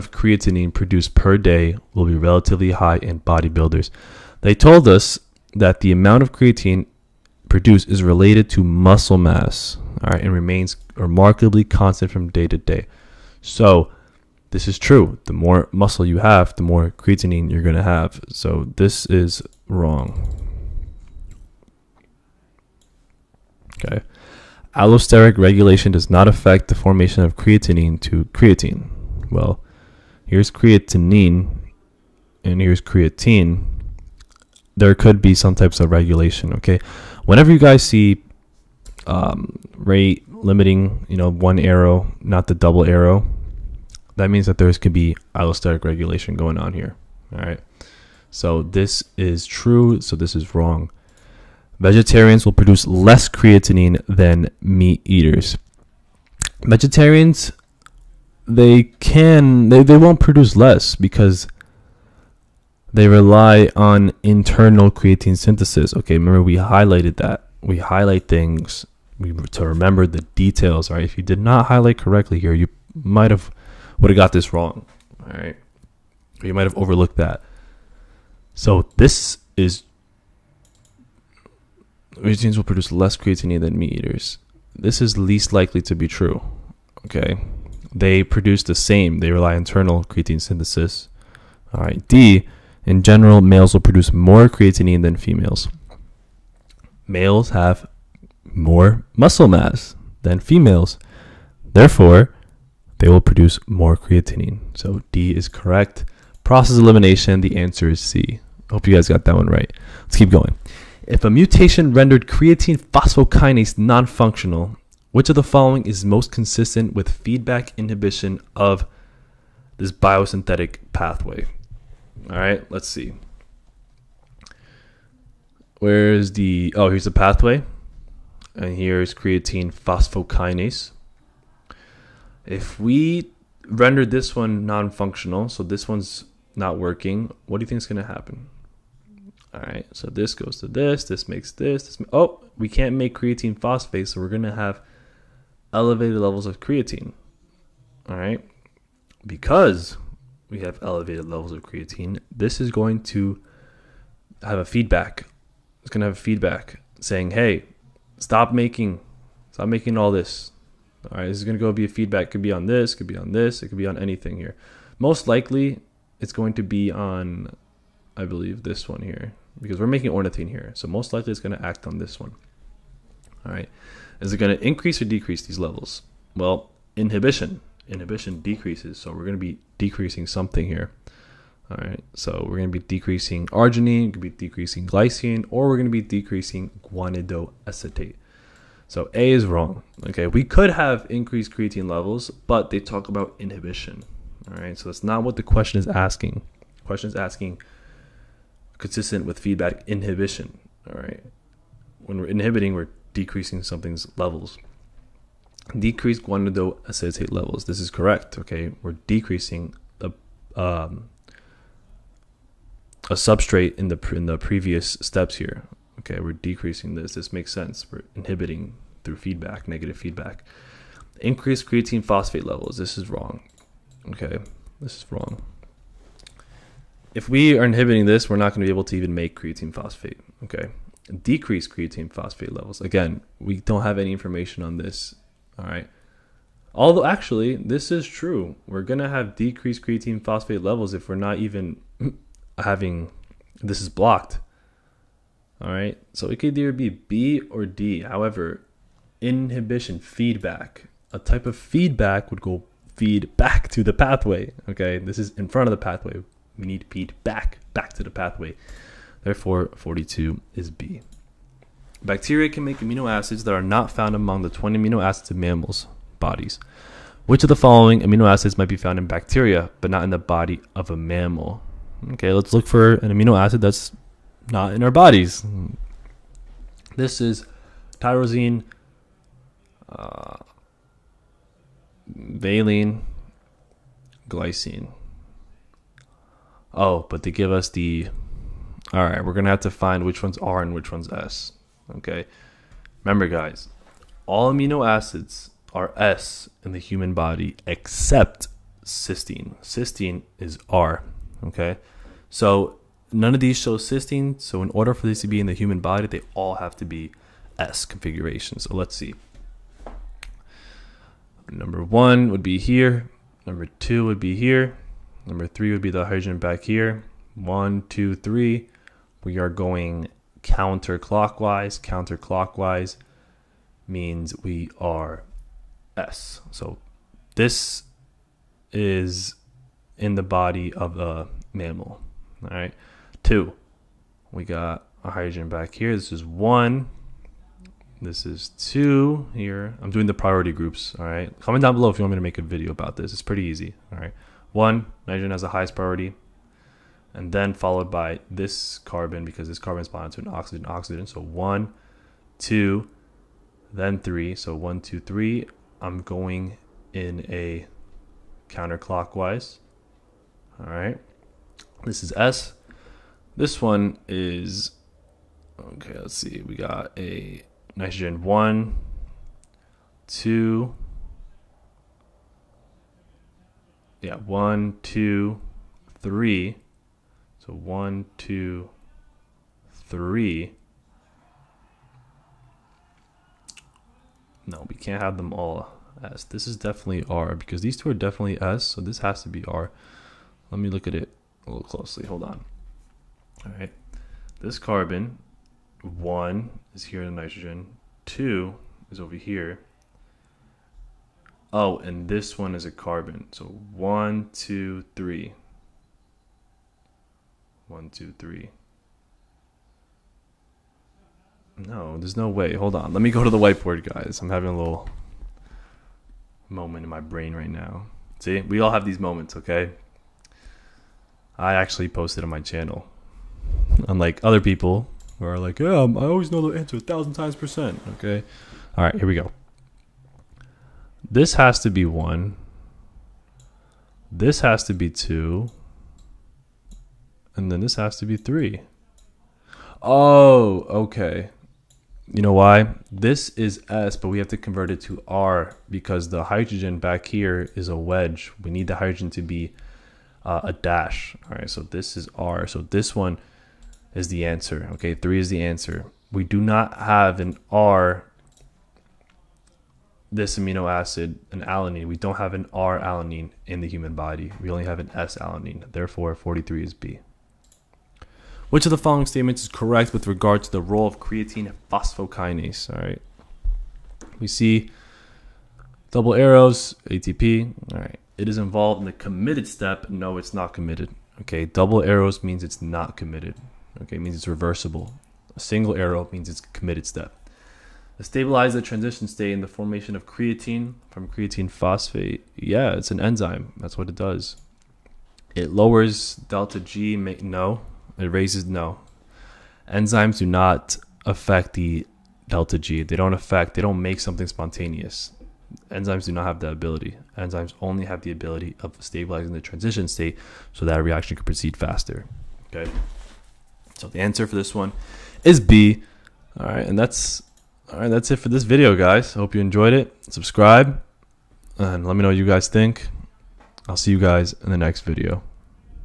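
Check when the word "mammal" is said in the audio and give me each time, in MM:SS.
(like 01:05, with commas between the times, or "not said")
04:25, 04:30, 05:31.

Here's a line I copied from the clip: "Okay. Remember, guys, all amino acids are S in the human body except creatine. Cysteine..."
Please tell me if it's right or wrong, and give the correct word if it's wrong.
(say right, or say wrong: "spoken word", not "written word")
wrong: "cysteine", not "creatine".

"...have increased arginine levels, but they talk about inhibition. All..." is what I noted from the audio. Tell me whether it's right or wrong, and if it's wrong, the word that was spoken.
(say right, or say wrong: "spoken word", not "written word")
wrong: "creatine", not "arginine".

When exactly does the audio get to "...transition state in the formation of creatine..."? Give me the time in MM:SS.
08:08.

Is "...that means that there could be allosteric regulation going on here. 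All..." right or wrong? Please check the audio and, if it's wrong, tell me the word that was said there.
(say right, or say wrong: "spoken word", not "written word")
right.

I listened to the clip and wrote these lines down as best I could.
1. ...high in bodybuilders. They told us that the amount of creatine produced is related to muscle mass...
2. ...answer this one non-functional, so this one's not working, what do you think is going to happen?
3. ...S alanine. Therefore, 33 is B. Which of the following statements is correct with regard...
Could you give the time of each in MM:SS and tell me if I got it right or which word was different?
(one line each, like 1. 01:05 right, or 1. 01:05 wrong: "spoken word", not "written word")
1. 00:02 right
2. 02:13 wrong: "render", not "answer"
3. 07:44 wrong: "43", not "33".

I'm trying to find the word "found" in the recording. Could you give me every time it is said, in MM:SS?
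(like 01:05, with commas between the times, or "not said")
04:23, 04:28.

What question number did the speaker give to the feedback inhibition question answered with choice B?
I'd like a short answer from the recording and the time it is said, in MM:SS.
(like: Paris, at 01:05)
42, at 04:19.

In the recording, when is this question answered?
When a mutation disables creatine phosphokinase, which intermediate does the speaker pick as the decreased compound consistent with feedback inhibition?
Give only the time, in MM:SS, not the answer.
03:26.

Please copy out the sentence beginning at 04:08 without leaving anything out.
However, inhibition, feedback, a type of feedback would go feed back to the pathway.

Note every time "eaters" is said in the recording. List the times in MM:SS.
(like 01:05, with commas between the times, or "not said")
00:55, 01:23.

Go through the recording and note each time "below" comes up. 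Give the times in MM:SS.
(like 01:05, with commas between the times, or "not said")
05:41.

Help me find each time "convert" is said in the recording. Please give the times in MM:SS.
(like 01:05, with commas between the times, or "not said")
07:24.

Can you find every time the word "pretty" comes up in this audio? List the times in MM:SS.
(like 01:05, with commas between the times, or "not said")
05:43.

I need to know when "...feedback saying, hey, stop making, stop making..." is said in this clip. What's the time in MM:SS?
02:36.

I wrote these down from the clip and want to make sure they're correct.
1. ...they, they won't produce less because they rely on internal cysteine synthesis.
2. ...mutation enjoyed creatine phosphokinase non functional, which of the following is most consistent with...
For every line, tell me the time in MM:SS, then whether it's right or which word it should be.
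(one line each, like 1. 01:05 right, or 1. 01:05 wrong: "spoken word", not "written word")
1. 00:59 wrong: "creatine", not "cysteine"
2. 01:51 wrong: "rendered", not "enjoyed".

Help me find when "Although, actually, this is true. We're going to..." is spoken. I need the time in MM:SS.
03:56.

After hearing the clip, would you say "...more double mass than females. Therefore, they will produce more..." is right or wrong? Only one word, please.
wrong.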